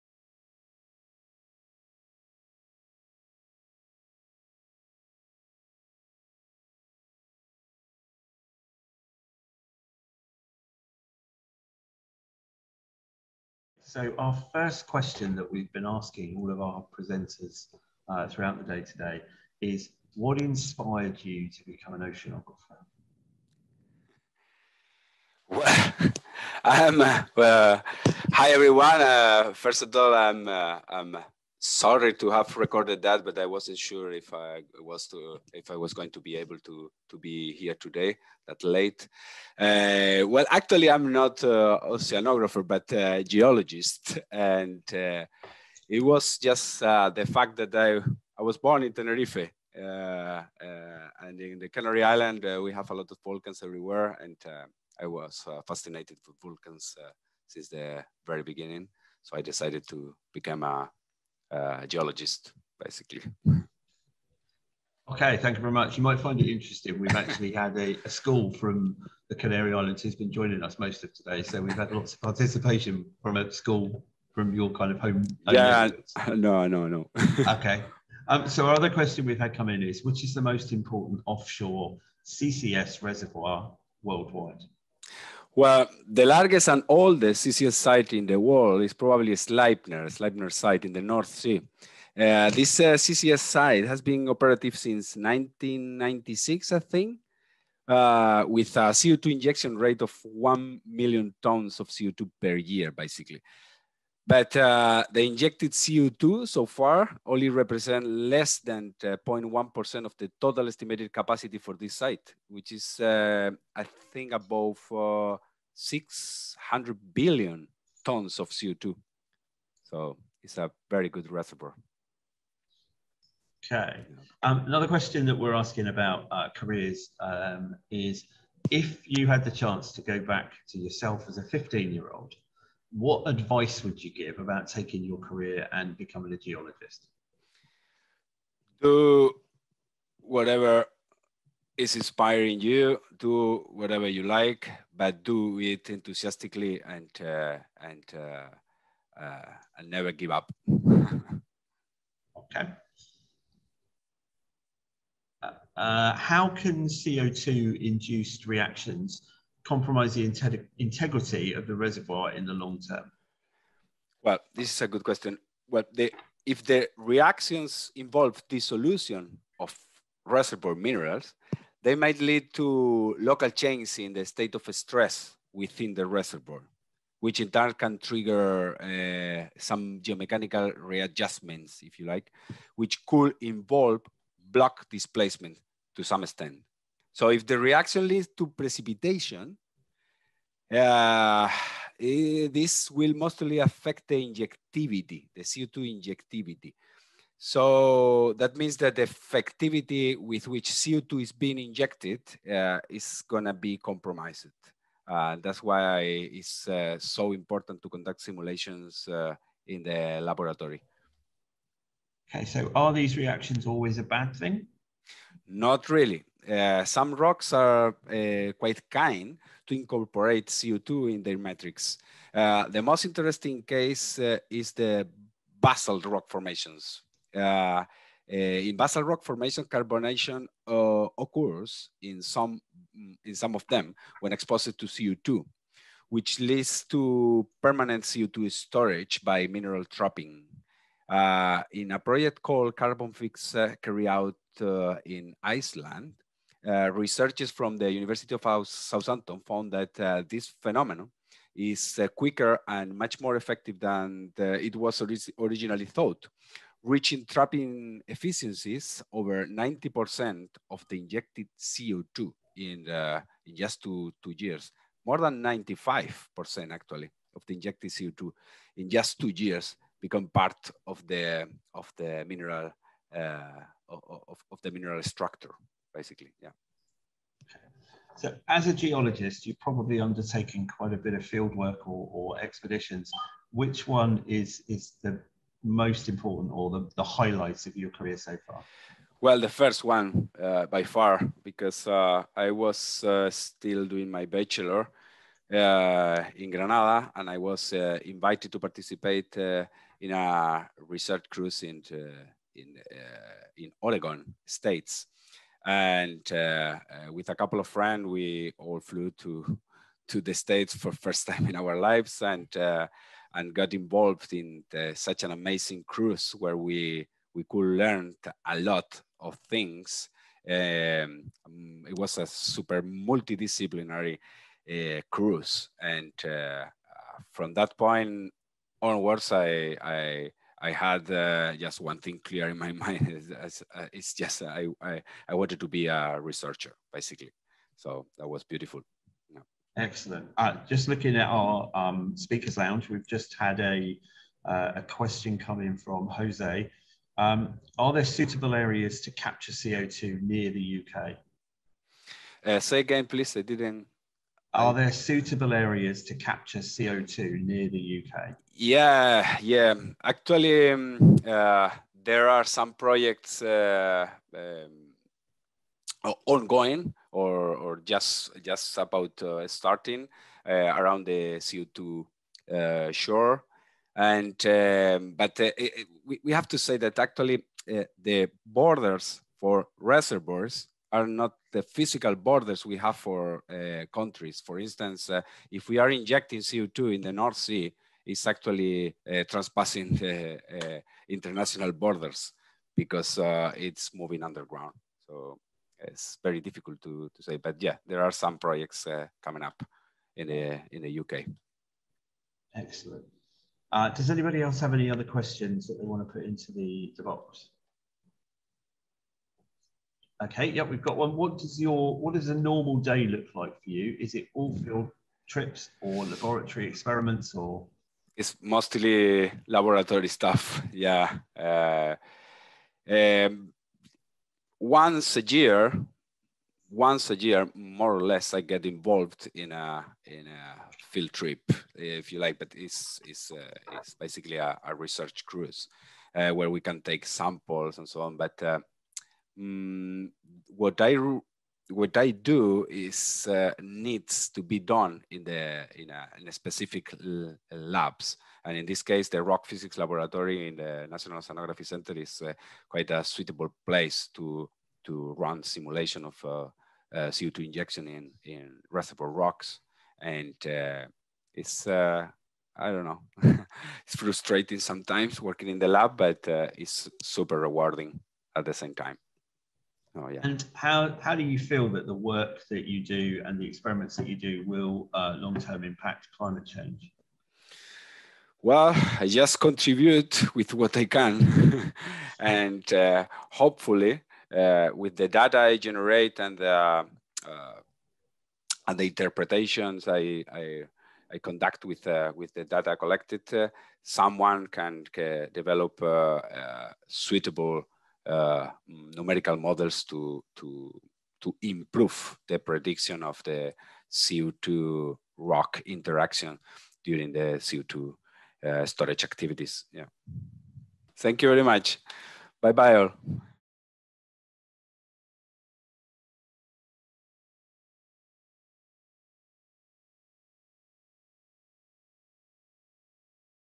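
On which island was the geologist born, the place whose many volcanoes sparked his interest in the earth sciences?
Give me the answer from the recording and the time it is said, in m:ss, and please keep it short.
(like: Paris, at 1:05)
Tenerife, at 0:48.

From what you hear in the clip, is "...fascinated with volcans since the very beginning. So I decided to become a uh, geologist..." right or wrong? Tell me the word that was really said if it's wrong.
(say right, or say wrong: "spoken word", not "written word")
right.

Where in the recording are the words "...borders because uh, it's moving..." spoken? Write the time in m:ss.
6:31.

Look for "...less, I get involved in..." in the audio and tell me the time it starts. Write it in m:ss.
7:08.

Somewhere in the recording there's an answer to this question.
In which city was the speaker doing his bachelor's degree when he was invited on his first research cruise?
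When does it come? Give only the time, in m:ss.
4:56.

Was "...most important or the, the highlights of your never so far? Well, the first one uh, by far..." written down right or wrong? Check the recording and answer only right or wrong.
wrong.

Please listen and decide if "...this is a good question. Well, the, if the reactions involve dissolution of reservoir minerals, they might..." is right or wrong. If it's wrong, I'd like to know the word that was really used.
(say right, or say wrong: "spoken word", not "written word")
right.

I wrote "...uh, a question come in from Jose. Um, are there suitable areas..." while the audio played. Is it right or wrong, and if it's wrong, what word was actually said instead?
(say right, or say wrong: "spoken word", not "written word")
right.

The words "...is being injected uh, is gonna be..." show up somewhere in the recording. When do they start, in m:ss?
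3:21.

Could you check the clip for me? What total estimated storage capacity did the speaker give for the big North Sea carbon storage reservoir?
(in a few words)
600 billion tons.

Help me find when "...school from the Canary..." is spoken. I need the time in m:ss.
1:08.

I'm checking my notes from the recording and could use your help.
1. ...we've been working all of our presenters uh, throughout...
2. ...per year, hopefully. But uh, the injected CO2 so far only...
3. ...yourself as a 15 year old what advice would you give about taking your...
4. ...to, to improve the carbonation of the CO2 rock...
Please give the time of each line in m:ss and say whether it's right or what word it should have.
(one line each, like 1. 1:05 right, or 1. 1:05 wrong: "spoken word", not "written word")
1. 0:15 wrong: "asking", not "working"
2. 1:42 wrong: "basically", not "hopefully"
3. 2:10 right
4. 8:20 wrong: "prediction", not "carbonation".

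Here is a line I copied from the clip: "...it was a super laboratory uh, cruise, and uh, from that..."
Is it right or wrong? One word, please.
wrong.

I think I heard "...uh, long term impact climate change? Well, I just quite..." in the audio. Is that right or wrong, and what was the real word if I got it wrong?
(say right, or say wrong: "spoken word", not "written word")
wrong: "contribute", not "quite".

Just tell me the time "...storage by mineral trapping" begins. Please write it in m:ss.
3:58.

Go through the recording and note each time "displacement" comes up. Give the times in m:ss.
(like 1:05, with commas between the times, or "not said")
3:04.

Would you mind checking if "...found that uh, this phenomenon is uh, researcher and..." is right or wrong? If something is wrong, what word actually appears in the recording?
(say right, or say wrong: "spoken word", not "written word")
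wrong: "quicker", not "researcher".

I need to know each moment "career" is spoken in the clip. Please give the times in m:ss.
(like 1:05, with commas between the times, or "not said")
2:06, 2:15, 4:47.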